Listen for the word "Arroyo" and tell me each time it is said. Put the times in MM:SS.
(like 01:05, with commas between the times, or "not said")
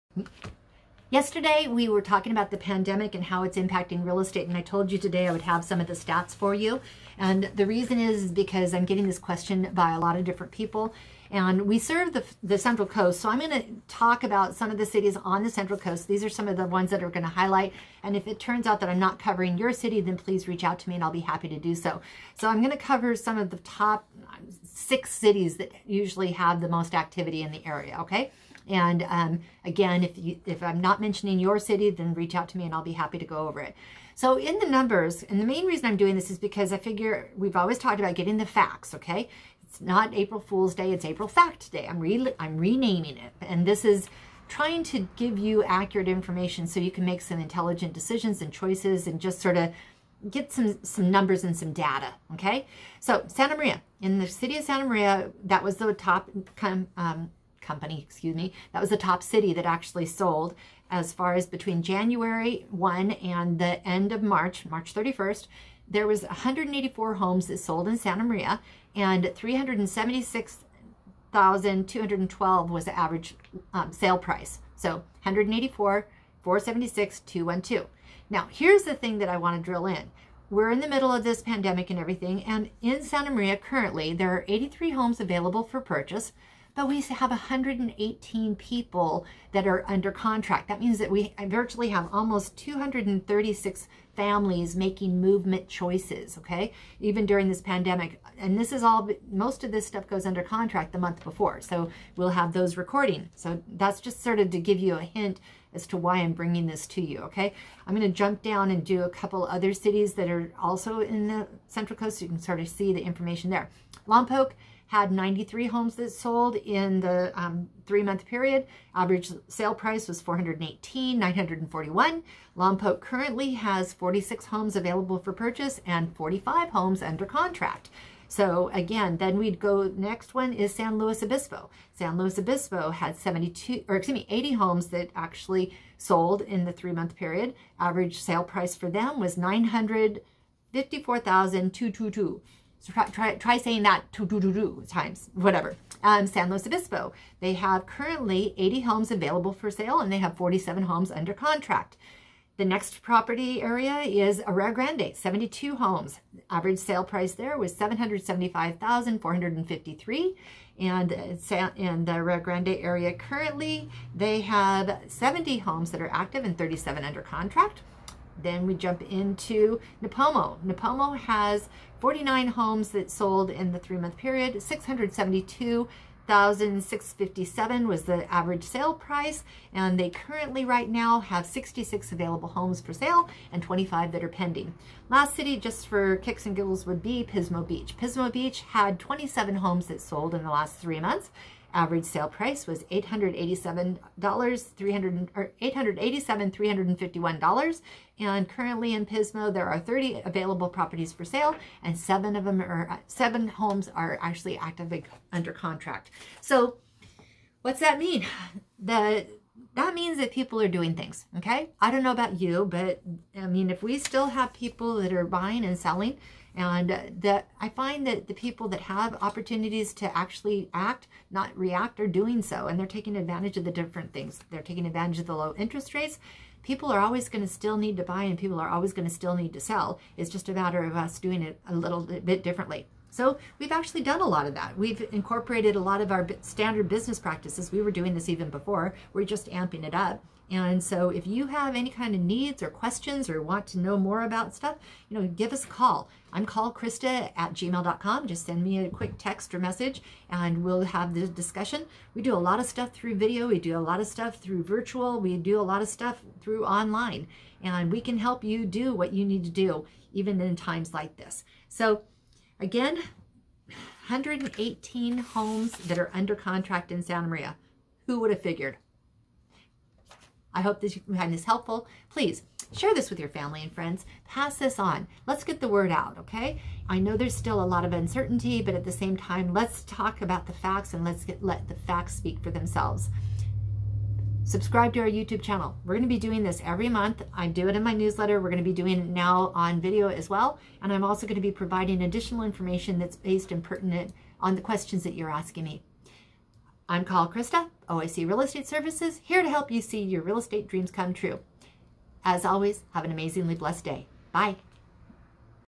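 02:34, 02:42.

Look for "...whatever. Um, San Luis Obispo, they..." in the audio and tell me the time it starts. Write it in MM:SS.
02:25.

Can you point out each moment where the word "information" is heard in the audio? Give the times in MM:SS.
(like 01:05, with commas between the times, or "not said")
00:46, 01:53, 04:52.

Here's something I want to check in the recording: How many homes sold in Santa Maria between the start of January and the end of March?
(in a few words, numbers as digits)
184.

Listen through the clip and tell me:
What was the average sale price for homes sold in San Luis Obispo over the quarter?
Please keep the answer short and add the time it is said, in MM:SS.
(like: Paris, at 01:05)
$954,222, at 02:19.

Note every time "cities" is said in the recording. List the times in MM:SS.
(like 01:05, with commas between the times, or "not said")
00:14, 00:25, 01:49.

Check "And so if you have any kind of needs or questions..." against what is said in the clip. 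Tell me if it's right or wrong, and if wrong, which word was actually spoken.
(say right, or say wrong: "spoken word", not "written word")
right.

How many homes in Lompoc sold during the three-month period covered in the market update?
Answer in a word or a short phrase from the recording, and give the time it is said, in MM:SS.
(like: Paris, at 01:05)
93, at 01:55.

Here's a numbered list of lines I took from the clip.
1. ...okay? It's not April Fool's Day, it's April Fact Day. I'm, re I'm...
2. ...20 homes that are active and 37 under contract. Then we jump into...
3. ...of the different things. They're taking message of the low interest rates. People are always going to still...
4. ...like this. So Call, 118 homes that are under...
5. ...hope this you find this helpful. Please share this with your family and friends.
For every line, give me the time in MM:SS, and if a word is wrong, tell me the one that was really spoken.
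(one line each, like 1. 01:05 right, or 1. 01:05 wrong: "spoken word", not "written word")
1. 00:38 right
2. 02:45 wrong: "70", not "20"
3. 03:43 wrong: "advantage", not "message"
4. 04:20 wrong: "Again", not "Call"
5. 04:30 right.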